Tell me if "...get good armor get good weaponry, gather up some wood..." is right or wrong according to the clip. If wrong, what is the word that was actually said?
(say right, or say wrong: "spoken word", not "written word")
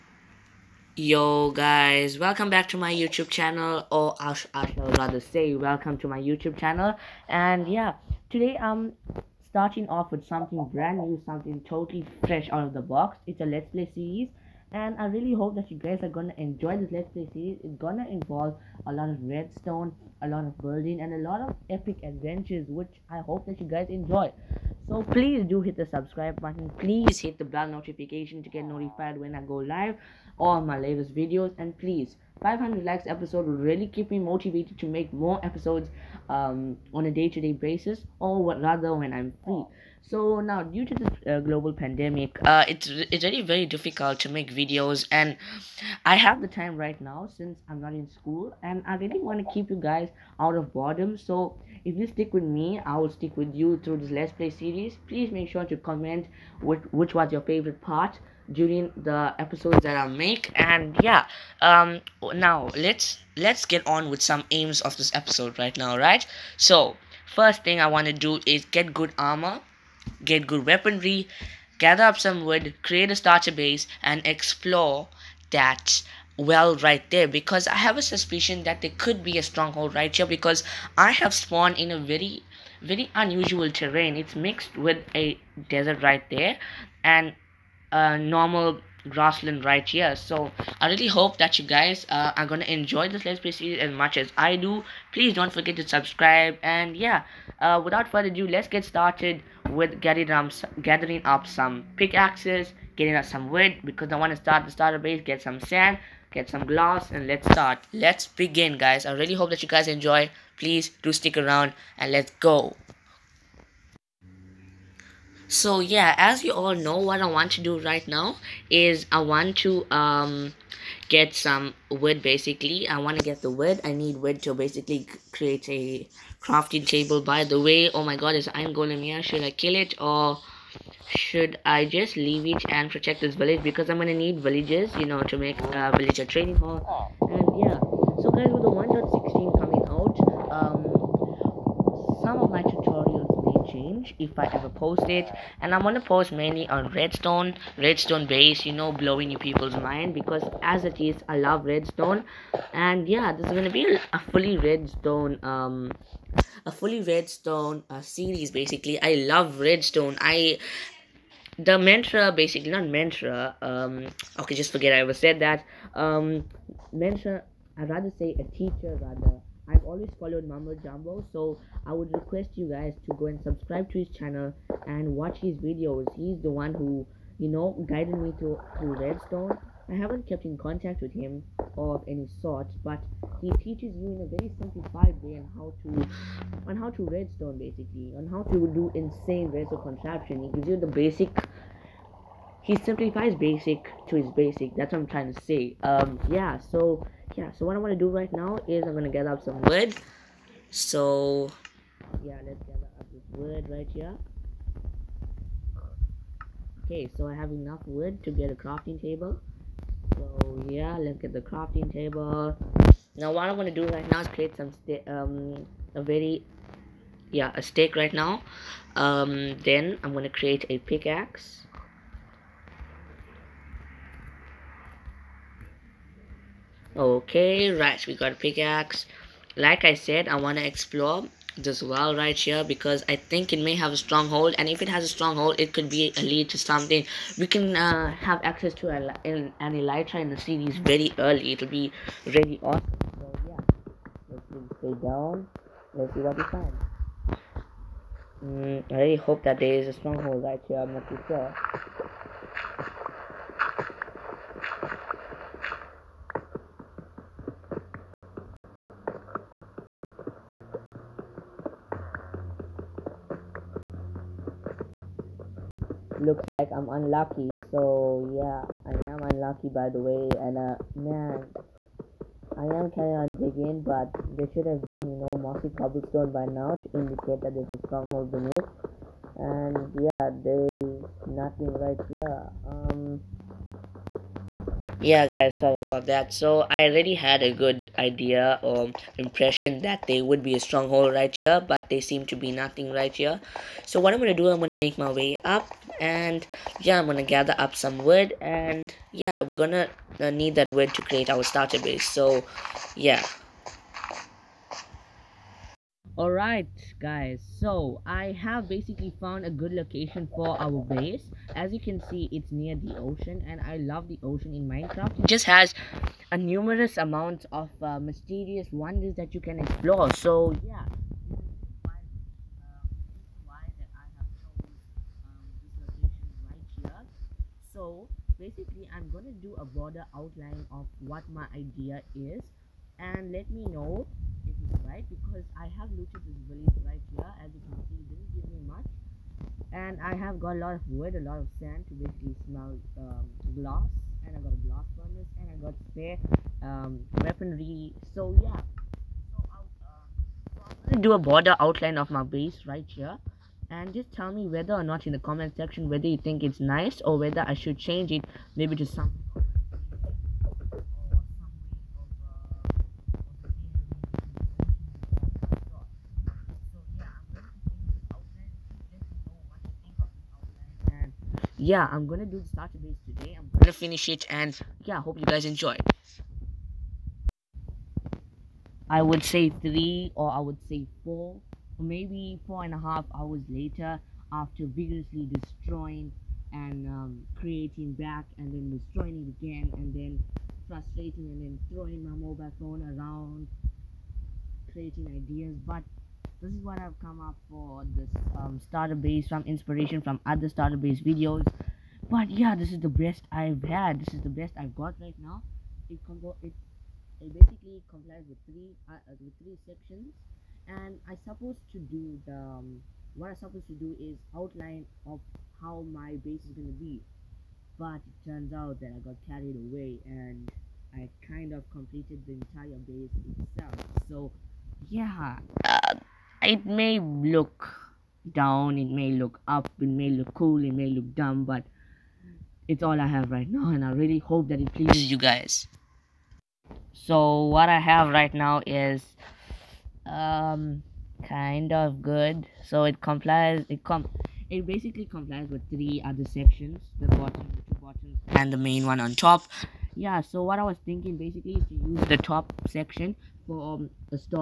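right.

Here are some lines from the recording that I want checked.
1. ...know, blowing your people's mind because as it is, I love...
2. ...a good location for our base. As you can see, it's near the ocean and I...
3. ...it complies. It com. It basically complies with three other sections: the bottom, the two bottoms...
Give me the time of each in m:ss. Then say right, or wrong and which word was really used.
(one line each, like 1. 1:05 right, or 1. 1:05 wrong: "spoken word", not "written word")
1. 2:28 right
2. 5:09 right
3. 7:22 right.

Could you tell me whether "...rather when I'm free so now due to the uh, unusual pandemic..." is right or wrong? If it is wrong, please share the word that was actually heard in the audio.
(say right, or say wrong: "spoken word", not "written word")
wrong: "global", not "unusual".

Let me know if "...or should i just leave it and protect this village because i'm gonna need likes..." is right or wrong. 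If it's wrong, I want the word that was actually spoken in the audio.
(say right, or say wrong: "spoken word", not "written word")
wrong: "villages", not "likes".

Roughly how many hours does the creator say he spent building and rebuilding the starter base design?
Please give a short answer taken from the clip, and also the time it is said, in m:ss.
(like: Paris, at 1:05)
4.5 hours, at 6:22.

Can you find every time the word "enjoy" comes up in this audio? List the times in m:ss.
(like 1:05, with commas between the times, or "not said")
0:16, 0:23, 1:32, 1:49, 6:15.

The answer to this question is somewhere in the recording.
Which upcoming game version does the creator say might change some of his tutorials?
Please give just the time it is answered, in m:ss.
2:18.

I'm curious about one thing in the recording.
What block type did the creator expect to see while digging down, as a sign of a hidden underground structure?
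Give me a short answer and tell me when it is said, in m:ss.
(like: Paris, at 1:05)
Mossy cobblestone, at 4:35.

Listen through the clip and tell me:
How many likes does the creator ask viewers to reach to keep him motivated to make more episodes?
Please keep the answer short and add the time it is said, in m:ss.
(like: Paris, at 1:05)
500, at 0:32.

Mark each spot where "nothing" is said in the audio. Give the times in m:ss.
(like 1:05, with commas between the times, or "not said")
4:41, 4:52.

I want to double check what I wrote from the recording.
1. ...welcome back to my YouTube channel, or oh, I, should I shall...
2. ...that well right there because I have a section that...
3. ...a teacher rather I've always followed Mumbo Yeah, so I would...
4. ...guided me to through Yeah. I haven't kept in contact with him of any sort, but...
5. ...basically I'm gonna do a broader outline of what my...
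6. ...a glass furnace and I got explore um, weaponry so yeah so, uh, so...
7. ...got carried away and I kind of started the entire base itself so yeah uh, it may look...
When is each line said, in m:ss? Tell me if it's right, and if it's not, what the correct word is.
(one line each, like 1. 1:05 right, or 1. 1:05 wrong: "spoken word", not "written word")
1. 0:02 right
2. 1:15 wrong: "suspicion", not "section"
3. 2:48 wrong: "Jumbo", not "Yeah"
4. 2:57 wrong: "Redstone", not "Yeah"
5. 5:28 right
6. 5:44 wrong: "spare", not "explore"
7. 6:59 wrong: "completed", not "started".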